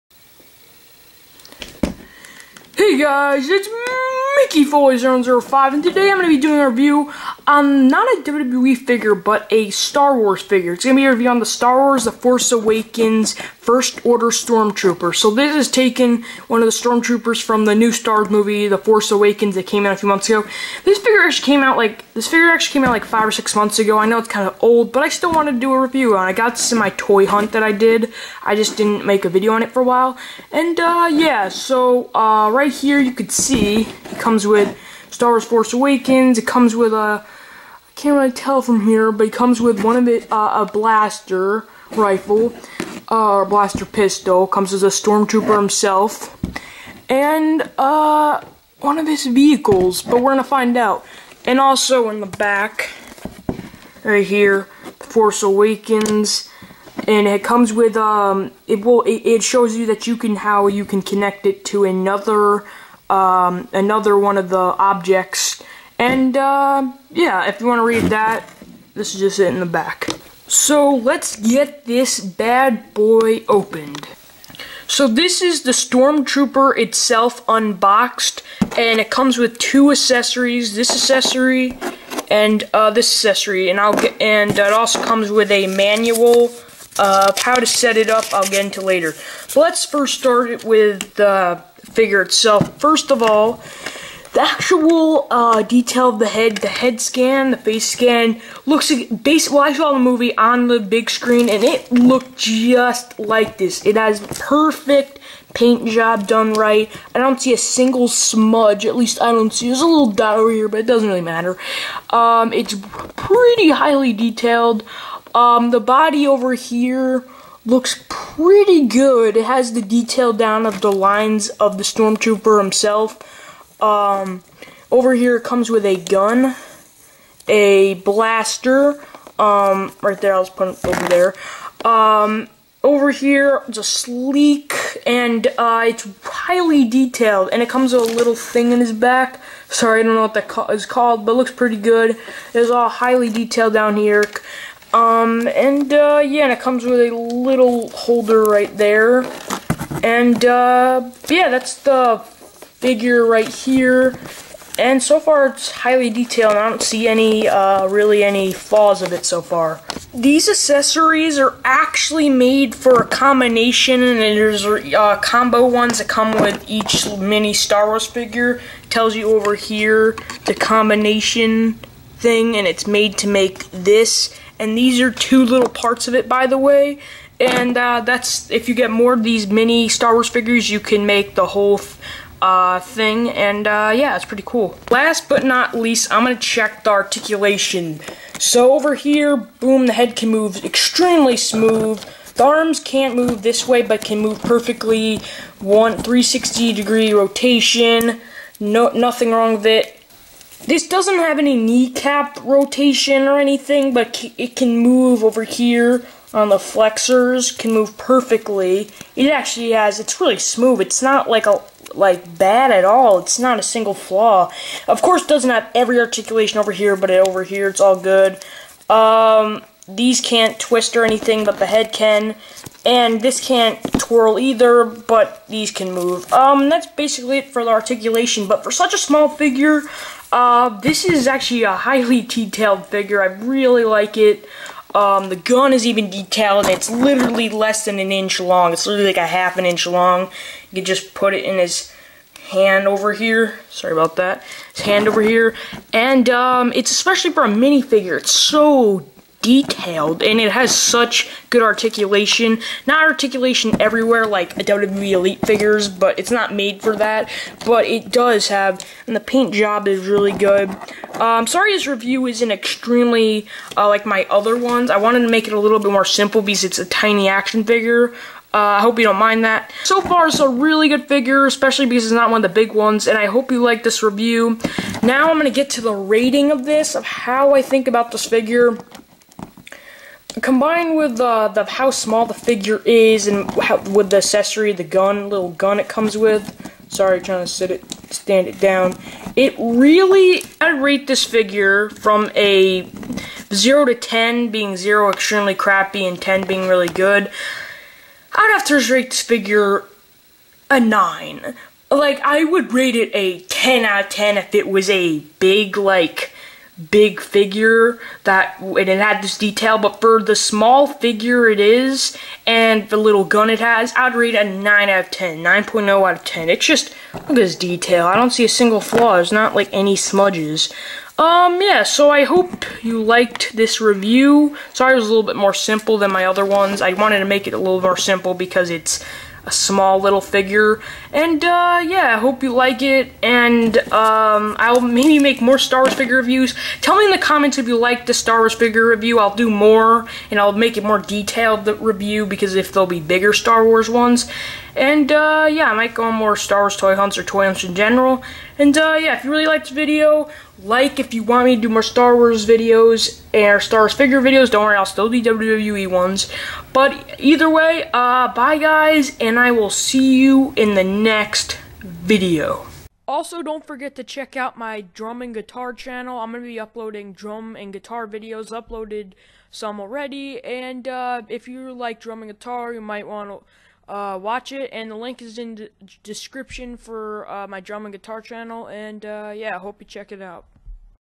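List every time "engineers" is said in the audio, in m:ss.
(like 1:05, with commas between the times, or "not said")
not said.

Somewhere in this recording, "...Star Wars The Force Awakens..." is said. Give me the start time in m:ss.
0:11.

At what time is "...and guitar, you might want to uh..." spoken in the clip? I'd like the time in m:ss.
6:12.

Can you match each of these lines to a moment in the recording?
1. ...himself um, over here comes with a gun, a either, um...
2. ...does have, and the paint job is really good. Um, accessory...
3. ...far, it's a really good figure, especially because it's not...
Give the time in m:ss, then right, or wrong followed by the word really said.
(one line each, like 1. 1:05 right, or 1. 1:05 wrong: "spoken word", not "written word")
1. 2:02 wrong: "blaster", not "either"
2. 4:18 wrong: "sorry", not "accessory"
3. 4:30 right.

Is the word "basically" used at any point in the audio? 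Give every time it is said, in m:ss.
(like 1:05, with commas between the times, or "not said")
1:39, 3:46.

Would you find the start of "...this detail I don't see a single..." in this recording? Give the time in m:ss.
5:17.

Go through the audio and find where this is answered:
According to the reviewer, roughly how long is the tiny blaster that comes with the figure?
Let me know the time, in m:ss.
3:59.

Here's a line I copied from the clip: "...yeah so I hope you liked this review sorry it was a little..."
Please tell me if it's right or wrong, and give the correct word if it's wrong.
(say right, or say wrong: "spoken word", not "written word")
right.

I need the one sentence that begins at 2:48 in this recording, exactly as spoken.
It tells you over here the combination thing and it's made to make this.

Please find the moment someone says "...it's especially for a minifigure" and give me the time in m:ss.
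4:06.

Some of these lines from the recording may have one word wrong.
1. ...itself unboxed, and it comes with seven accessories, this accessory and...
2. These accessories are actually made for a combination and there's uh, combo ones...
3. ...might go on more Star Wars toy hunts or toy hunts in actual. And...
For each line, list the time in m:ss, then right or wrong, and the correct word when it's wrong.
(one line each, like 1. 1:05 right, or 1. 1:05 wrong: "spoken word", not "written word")
1. 1:16 wrong: "two", not "seven"
2. 2:40 right
3. 5:45 wrong: "general", not "actual".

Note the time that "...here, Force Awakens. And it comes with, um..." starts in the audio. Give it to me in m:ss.
0:54.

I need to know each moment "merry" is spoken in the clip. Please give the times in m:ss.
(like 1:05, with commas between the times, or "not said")
not said.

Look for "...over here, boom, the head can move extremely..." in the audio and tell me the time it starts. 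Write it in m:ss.
3:08.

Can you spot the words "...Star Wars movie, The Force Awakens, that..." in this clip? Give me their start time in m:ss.
0:17.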